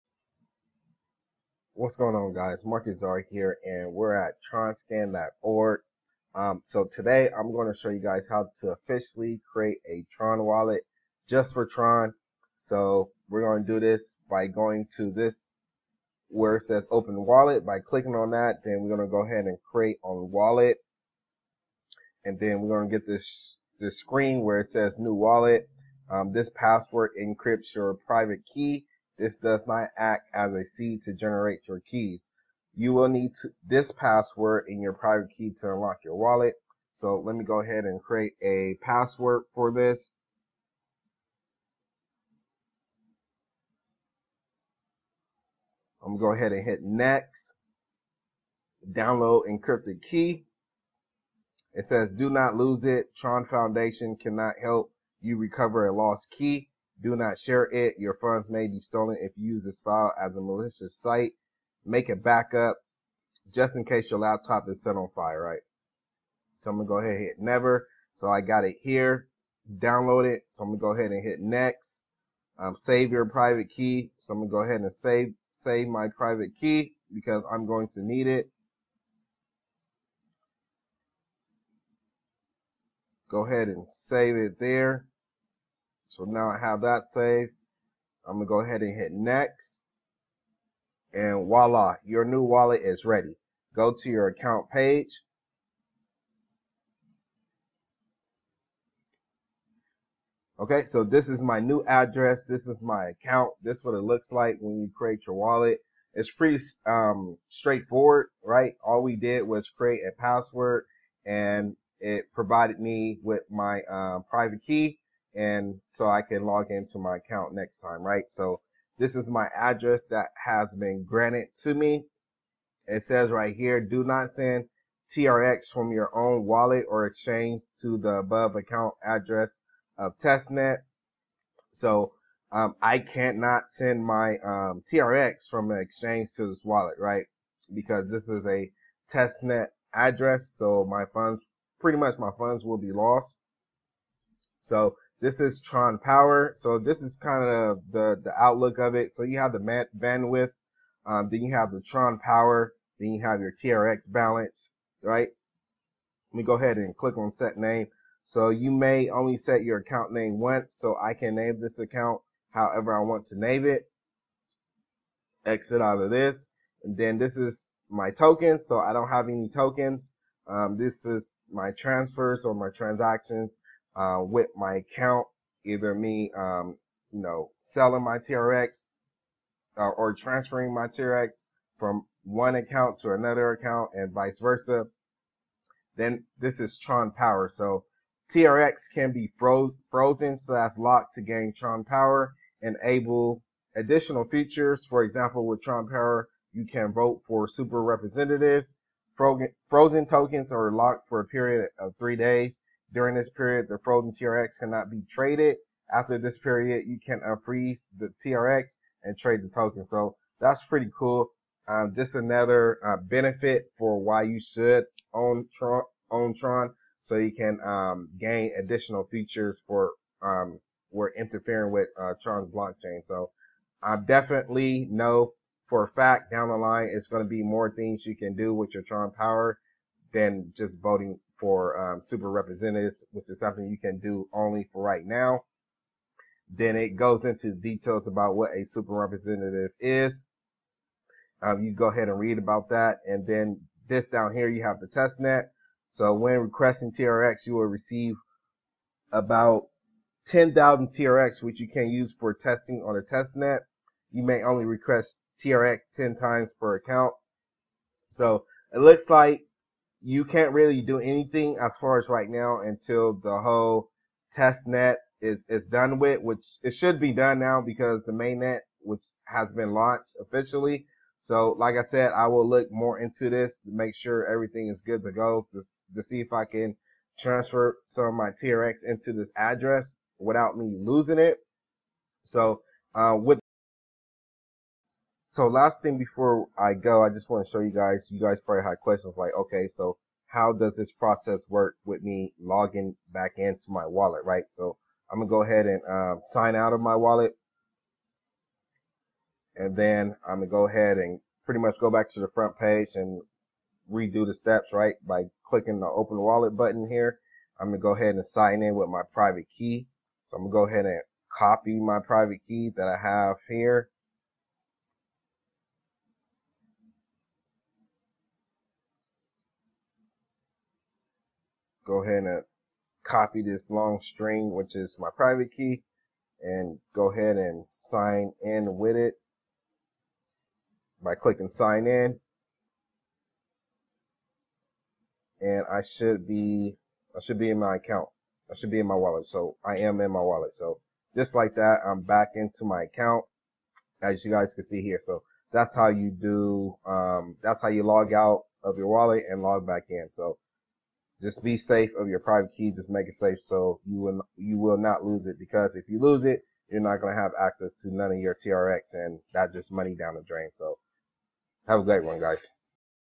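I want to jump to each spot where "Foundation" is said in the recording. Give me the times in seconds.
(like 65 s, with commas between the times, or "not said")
53 s.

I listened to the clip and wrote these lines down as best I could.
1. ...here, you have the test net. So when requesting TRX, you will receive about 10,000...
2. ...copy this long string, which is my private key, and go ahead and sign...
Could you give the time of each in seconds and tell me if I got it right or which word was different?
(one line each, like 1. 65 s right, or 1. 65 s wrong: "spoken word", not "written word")
1. 244 s right
2. 323 s right.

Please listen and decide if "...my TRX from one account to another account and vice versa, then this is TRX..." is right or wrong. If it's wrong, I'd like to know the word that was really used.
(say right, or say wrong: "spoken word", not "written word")
wrong: "Tron", not "TRX".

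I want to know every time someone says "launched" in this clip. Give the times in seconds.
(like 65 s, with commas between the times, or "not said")
269 s.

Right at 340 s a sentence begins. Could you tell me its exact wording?
So just like that, I'm back into my account as you guys can see here.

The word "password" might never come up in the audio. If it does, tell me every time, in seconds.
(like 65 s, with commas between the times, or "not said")
26 s, 33 s, 38 s, 110 s.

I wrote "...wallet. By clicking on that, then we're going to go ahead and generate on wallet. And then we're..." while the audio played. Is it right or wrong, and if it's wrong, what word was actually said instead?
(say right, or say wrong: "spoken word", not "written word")
wrong: "create", not "generate".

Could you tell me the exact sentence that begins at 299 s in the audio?
And then I'm going to go ahead and pretty much go back to the front page and redo the steps, right?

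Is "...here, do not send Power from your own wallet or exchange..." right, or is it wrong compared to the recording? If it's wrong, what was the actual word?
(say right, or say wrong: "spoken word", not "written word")
wrong: "TRX", not "Power".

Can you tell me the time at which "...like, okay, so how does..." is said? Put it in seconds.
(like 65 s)
289 s.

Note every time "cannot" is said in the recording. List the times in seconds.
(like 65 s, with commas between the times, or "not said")
54 s, 132 s, 204 s.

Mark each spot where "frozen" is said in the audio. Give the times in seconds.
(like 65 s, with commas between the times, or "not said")
189 s, 199 s, 203 s.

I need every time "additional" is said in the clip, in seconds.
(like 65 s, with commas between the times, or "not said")
193 s, 218 s.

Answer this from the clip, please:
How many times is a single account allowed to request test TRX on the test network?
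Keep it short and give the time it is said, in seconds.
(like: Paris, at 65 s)
10 times, at 255 s.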